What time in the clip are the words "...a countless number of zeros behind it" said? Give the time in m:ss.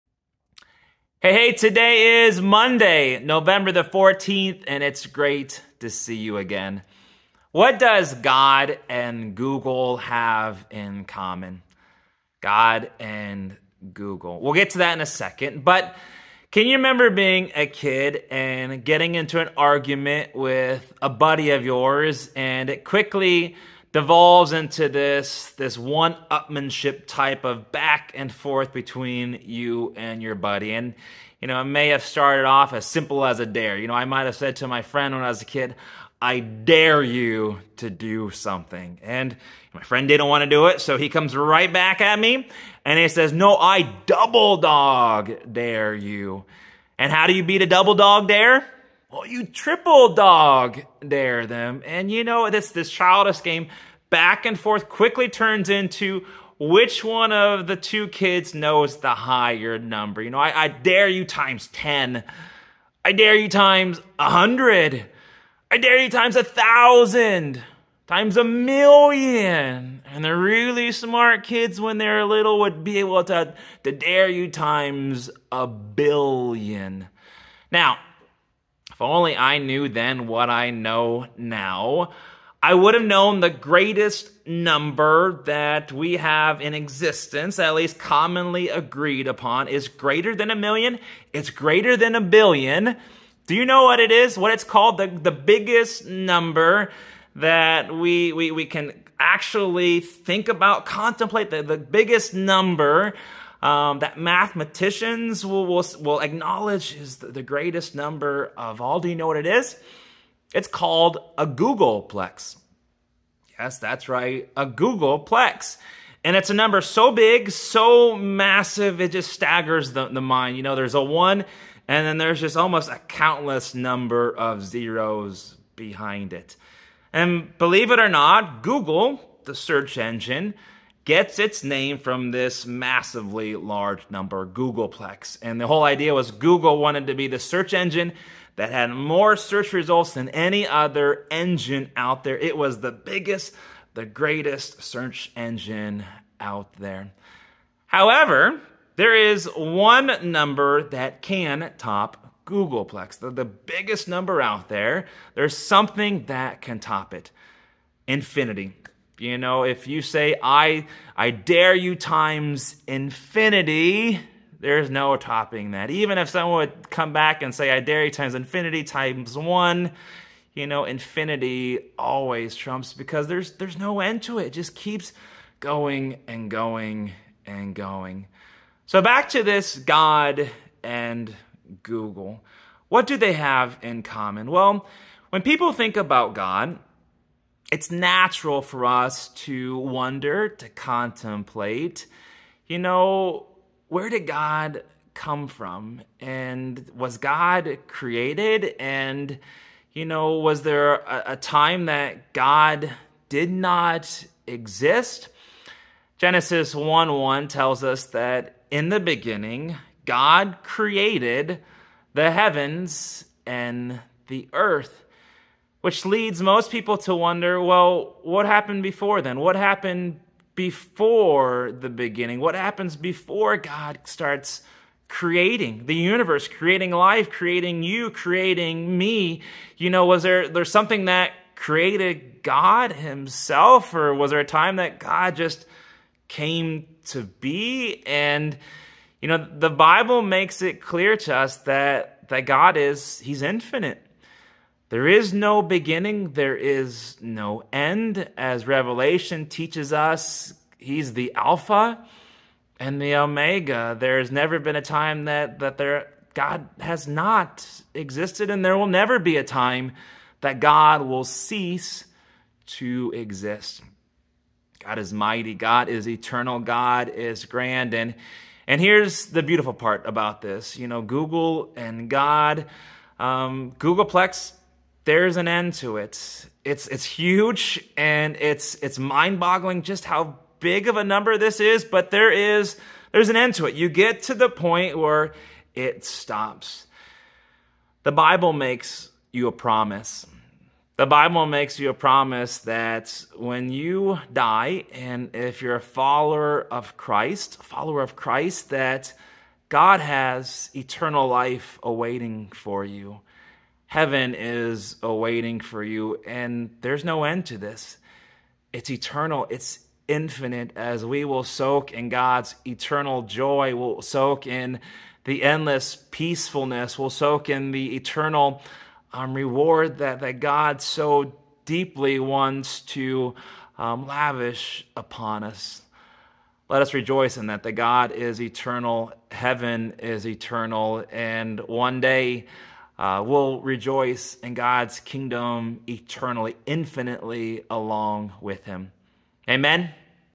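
2:02.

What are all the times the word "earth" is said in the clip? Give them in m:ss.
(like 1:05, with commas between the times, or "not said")
3:34.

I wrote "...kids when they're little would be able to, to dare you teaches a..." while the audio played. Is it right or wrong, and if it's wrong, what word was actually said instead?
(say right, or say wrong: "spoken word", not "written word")
wrong: "times", not "teaches".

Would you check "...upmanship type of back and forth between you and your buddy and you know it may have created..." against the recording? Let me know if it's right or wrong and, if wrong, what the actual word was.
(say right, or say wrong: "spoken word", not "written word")
wrong: "started", not "created".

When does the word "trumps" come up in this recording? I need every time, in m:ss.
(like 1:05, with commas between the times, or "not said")
2:52.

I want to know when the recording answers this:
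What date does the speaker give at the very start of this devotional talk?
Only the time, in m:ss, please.
0:02.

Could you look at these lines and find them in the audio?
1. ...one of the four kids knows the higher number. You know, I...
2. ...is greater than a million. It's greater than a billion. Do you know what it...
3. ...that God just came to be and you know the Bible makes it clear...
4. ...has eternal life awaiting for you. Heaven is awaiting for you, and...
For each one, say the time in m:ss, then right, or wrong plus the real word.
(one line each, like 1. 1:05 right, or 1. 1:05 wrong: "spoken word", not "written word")
1. 0:57 wrong: "two", not "four"
2. 1:29 right
3. 3:54 right
4. 4:59 right.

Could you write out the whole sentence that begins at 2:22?
It was the biggest, the greatest search engine out there.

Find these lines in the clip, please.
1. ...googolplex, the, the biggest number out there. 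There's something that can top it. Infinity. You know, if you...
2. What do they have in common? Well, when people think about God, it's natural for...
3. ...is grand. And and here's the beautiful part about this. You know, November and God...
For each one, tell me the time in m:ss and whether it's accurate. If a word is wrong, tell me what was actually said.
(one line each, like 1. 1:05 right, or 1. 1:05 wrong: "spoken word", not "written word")
1. 2:32 right
2. 3:02 right
3. 4:27 wrong: "Google", not "November".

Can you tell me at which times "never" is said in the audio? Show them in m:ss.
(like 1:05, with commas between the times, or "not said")
4:14, 4:18.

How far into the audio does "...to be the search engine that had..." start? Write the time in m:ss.
2:17.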